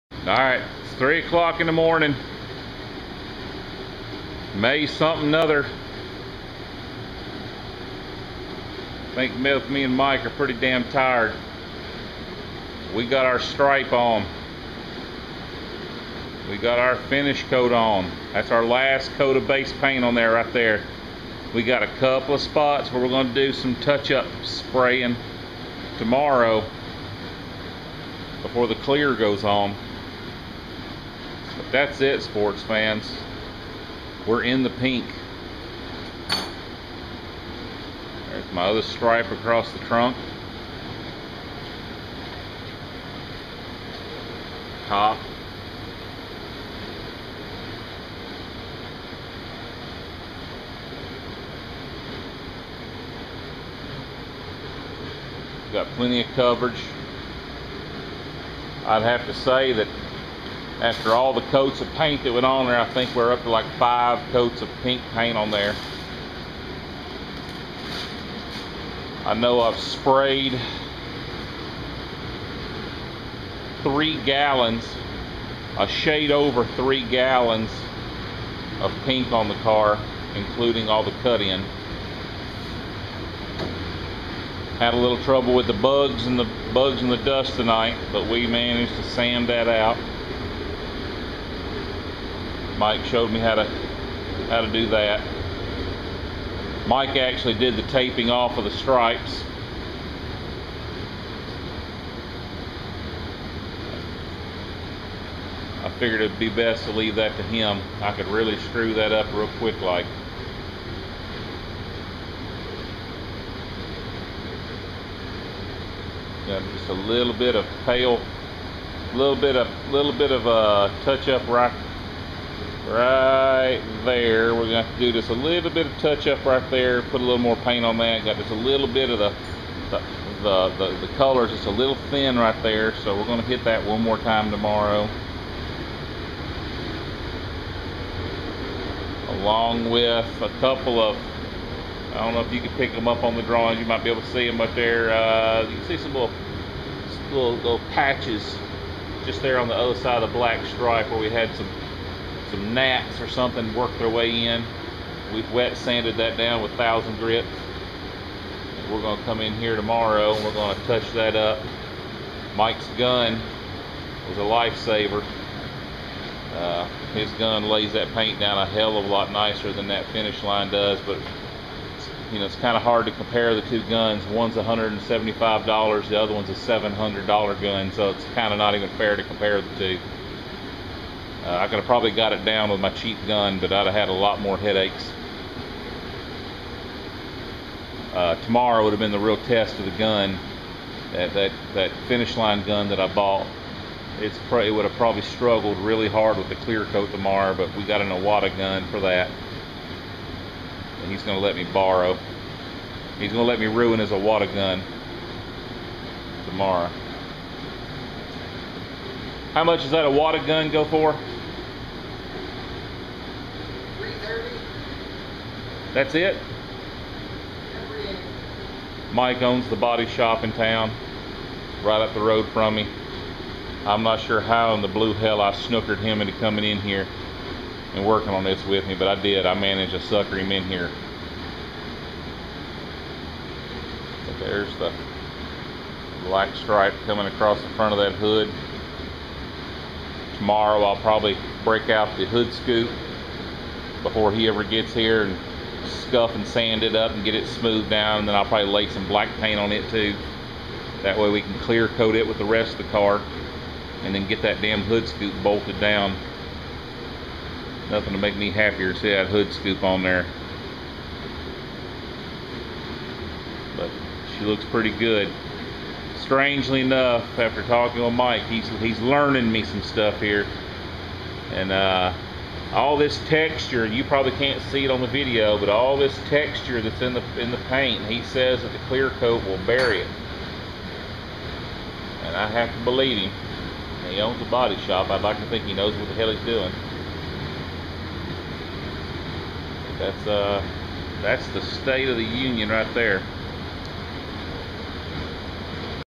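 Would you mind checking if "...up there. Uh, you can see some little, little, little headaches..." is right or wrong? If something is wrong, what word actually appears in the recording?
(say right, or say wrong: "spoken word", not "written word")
wrong: "patches", not "headaches".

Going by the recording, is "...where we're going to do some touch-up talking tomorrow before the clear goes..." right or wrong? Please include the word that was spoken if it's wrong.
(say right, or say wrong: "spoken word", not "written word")
wrong: "spraying", not "talking".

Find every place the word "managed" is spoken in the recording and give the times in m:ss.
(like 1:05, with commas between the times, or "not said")
1:28, 3:49.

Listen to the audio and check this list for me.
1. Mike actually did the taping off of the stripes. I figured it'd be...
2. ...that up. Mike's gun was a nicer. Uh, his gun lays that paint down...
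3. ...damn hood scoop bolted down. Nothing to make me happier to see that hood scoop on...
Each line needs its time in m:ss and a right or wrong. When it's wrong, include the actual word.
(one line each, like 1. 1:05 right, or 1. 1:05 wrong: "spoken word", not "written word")
1. 1:36 right
2. 2:41 wrong: "lifesaver", not "nicer"
3. 4:14 right.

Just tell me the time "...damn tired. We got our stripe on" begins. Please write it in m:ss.
0:10.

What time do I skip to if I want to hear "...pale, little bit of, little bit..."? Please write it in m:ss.
1:57.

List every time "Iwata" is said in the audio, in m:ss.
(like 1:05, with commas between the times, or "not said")
3:18, 3:24, 3:30.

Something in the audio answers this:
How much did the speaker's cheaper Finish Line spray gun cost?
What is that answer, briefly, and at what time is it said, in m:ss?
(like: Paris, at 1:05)
$175, at 2:54.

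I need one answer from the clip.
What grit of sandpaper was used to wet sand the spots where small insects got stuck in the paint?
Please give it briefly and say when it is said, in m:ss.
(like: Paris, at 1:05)
1000 grit, at 2:36.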